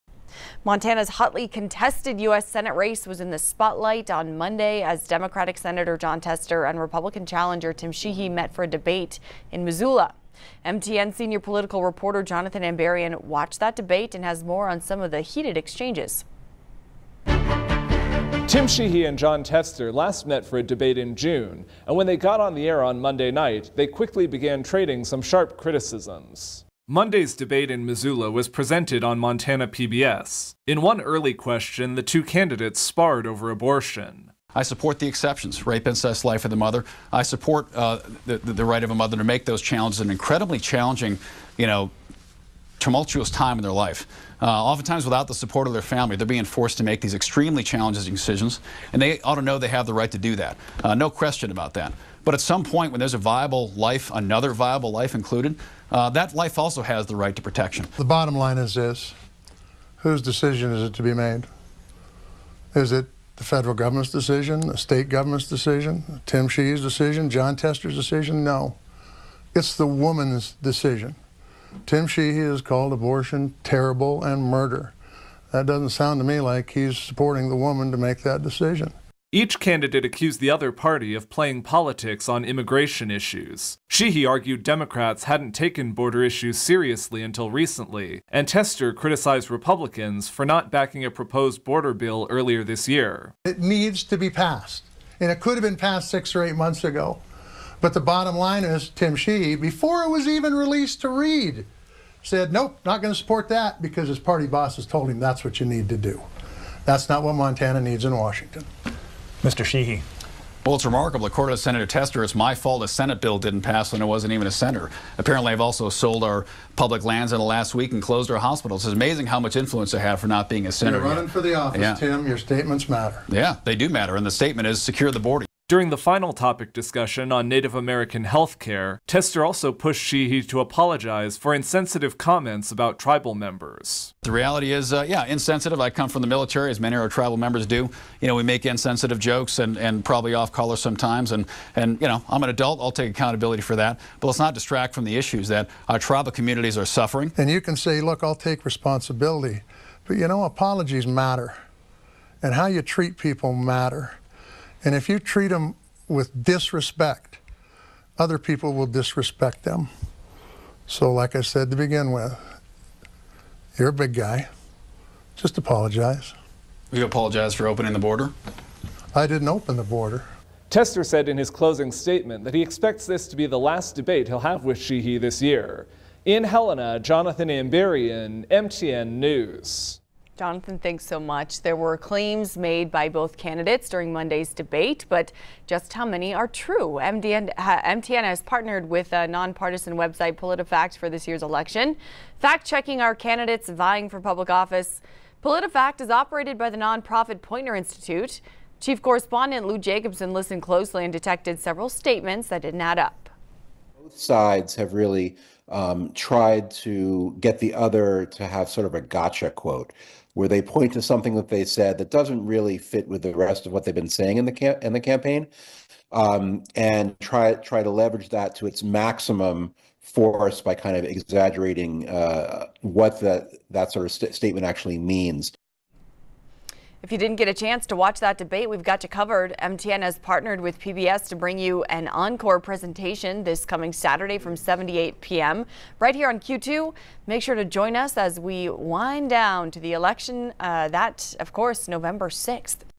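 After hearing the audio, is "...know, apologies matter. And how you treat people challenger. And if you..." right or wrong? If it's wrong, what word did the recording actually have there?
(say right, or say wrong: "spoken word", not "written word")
wrong: "matter", not "challenger".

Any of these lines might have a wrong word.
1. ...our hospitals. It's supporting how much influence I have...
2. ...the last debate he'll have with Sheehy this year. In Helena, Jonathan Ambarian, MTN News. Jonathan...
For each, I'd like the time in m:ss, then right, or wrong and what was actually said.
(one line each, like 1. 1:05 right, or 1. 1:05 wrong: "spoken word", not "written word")
1. 1:58 wrong: "amazing", not "supporting"
2. 2:53 right.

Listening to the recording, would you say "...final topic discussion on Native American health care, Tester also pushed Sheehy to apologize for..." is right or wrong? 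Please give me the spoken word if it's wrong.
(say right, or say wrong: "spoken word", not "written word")
right.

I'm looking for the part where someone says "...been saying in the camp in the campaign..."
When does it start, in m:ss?
3:33.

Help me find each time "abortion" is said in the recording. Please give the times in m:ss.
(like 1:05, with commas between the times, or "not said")
0:33, 1:12.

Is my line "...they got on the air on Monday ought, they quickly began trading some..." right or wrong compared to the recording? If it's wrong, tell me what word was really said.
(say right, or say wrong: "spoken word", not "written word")
wrong: "night", not "ought".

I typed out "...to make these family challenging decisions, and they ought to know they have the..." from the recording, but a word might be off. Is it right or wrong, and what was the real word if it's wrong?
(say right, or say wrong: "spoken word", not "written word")
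wrong: "extremely", not "family".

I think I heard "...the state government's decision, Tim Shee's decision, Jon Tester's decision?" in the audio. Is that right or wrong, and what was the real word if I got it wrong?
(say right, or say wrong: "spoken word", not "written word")
right.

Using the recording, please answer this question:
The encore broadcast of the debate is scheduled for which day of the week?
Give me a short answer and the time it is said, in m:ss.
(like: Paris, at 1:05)
Saturday, at 3:53.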